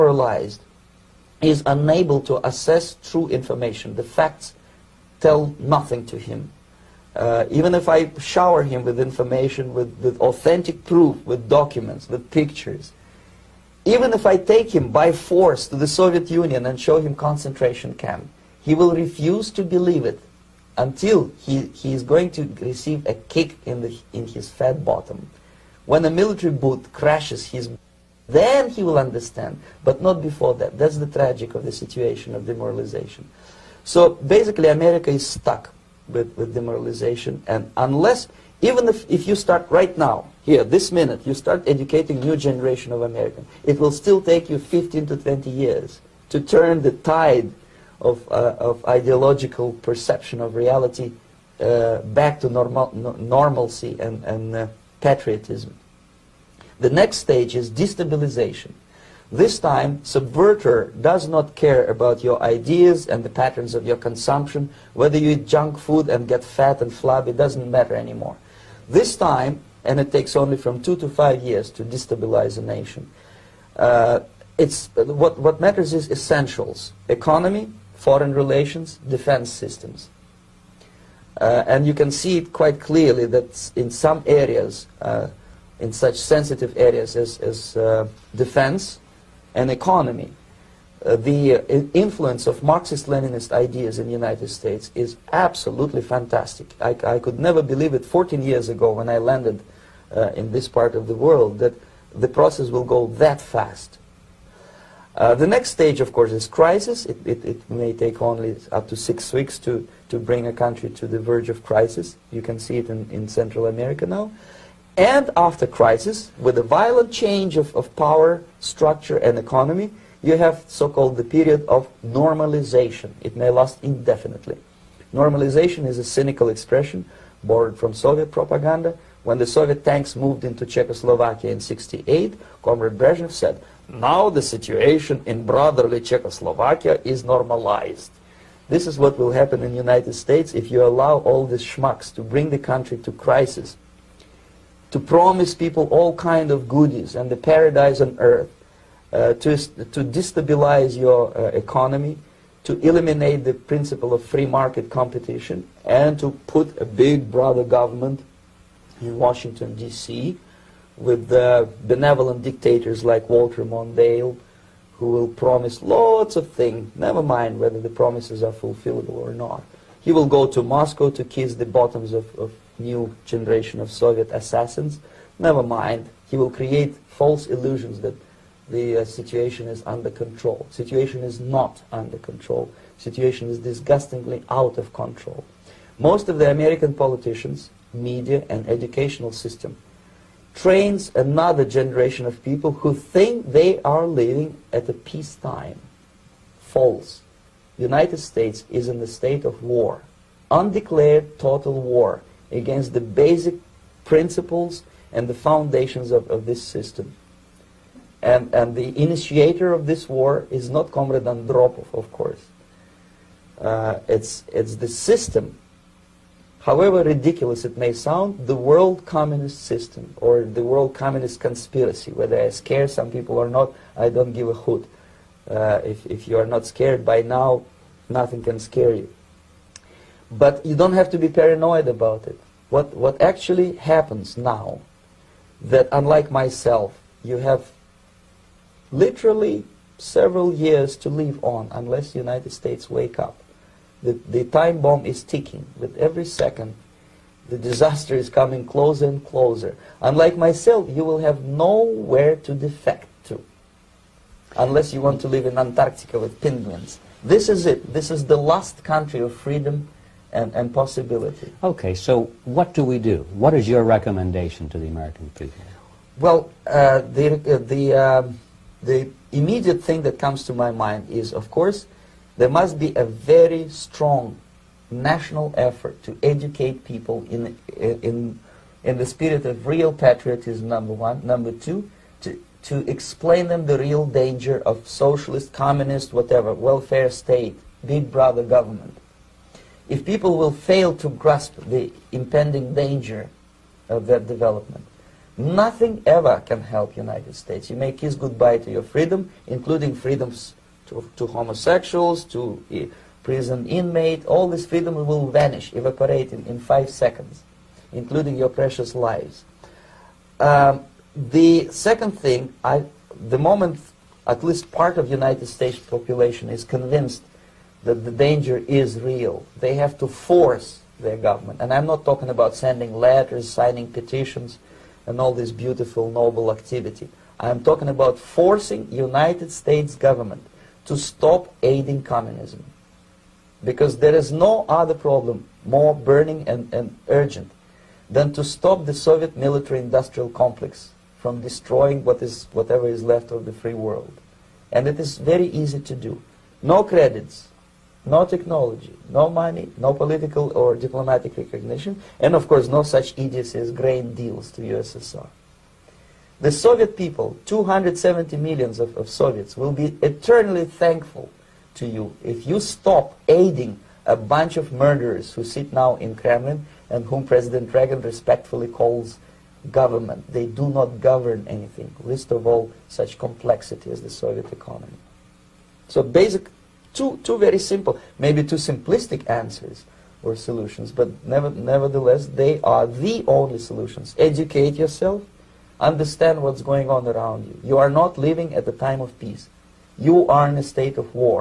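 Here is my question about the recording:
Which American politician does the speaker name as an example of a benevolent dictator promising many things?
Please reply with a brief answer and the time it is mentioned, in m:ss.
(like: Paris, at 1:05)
Walter Mondale, at 2:43.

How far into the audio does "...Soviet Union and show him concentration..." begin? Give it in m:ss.
0:15.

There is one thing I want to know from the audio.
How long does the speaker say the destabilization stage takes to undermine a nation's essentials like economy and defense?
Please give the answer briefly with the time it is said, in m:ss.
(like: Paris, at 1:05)
2 to 5 years, at 1:10.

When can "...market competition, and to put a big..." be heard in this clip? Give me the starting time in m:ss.
2:34.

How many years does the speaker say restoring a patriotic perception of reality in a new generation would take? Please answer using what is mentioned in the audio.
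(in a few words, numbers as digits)
15 to 20.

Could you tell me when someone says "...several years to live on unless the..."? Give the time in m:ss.
3:59.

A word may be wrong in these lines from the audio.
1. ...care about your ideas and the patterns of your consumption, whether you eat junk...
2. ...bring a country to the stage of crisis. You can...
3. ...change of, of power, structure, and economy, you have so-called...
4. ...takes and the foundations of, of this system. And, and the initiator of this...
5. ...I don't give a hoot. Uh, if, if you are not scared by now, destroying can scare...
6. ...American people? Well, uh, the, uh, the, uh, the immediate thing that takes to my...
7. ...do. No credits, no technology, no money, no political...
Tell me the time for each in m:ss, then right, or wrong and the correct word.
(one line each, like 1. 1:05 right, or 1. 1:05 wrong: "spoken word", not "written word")
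1. 1:01 right
2. 1:50 wrong: "verge", not "stage"
3. 1:57 right
4. 3:24 wrong: "principles", not "takes"
5. 3:43 wrong: "nothing", not "destroying"
6. 4:24 wrong: "comes", not "takes"
7. 5:45 right.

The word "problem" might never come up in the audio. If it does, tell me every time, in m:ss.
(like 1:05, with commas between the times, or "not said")
5:34.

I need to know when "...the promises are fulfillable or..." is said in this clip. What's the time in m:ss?
2:47.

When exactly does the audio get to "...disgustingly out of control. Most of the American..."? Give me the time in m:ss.
3:03.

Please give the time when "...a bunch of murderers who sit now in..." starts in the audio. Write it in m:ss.
6:04.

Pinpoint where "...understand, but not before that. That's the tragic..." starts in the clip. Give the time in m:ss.
0:28.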